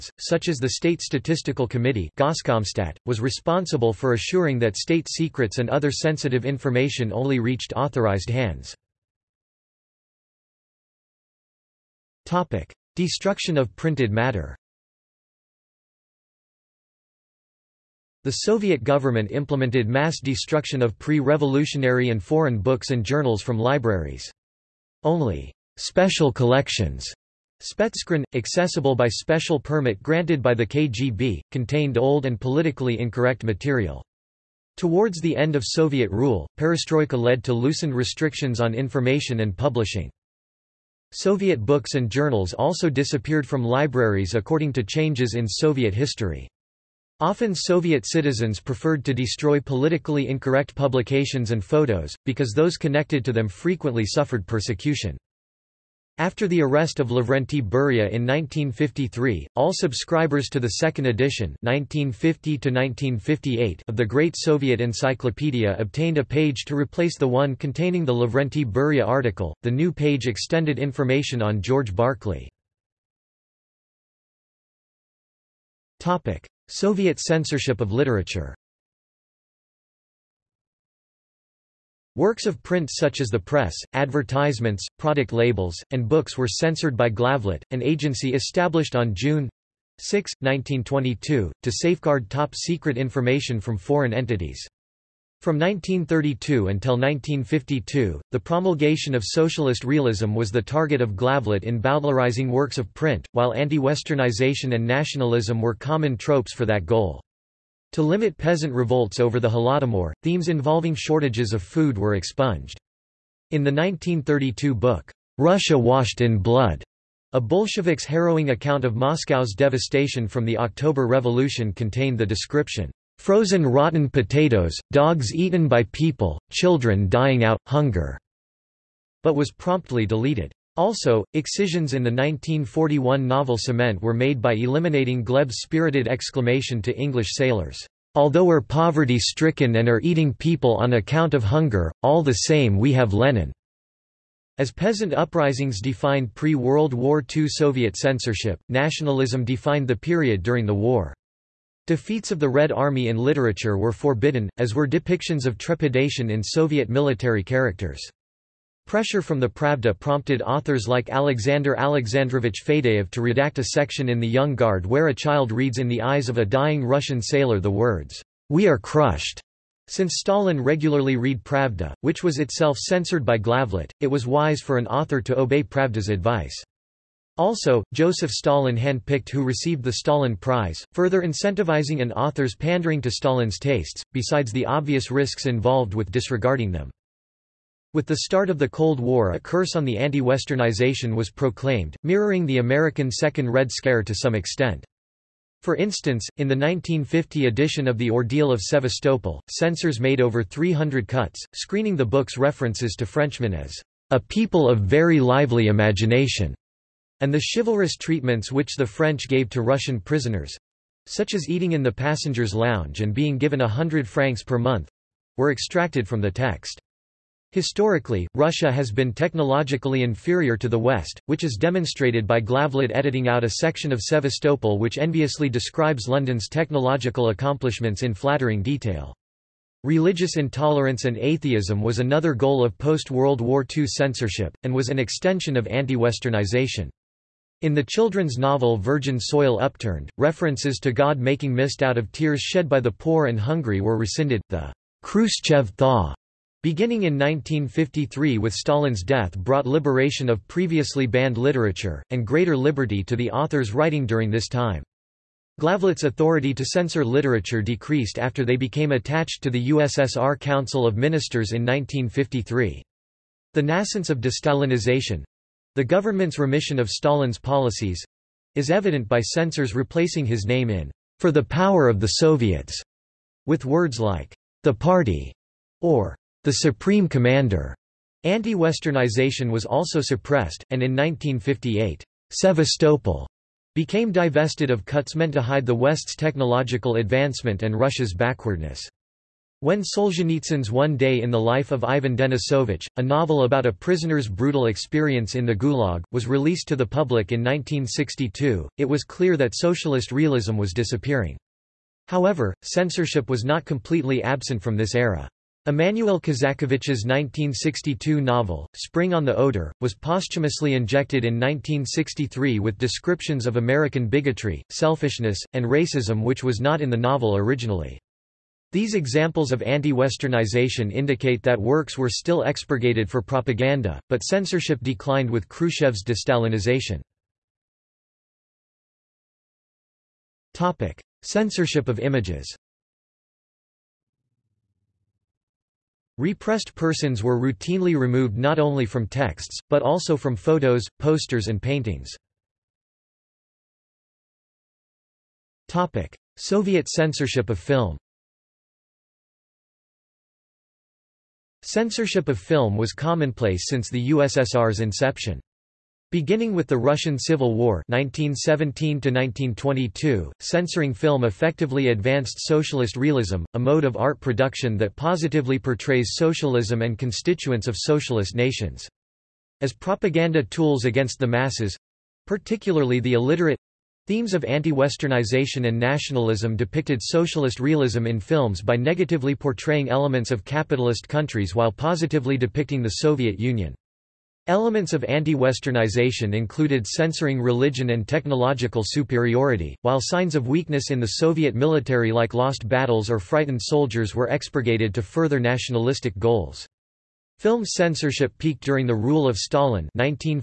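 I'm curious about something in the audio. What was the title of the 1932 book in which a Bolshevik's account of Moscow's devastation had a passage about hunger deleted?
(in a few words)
Russia Washed in Blood.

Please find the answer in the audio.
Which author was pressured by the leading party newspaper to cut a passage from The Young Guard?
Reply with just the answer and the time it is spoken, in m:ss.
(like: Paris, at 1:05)
Alexander Alexandrovich Fadeev, at 2:41.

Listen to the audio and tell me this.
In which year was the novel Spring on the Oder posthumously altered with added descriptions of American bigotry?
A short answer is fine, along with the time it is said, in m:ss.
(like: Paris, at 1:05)
1963, at 5:11.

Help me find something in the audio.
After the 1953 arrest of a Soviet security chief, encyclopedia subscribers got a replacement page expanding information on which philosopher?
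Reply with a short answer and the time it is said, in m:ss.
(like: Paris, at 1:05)
George Berkeley, at 1:11.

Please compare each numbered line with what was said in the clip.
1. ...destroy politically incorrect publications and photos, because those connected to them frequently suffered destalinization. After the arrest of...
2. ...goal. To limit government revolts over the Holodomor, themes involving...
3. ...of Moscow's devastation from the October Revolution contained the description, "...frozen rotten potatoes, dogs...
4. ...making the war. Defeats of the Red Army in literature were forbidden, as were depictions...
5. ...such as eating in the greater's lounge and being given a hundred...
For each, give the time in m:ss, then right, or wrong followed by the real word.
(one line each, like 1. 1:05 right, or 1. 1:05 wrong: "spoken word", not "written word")
1. 0:49 wrong: "persecution", not "destalinization"
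2. 1:46 wrong: "peasant", not "government"
3. 1:58 right
4. 2:30 wrong: "during", not "making"
5. 3:31 wrong: "passenger", not "greater".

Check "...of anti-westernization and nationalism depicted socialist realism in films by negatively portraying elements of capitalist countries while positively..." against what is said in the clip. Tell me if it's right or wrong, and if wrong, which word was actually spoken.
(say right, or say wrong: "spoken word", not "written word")
right.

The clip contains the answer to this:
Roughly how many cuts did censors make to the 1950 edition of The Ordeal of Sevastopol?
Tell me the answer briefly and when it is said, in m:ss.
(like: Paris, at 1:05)
over 300, at 3:20.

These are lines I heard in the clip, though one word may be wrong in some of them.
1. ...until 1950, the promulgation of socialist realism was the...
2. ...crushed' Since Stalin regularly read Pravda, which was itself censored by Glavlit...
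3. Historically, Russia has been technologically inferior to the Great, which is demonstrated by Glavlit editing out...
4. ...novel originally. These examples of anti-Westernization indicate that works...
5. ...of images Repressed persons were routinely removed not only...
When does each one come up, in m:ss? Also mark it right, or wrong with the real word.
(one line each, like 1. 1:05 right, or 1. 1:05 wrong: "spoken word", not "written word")
1. 1:36 wrong: "1952", not "1950"
2. 2:48 right
3. 3:37 wrong: "West", not "Great"
4. 5:16 right
5. 5:31 right.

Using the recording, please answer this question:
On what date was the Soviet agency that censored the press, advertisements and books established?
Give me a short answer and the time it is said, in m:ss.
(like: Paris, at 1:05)
June 6, 1922, at 1:29.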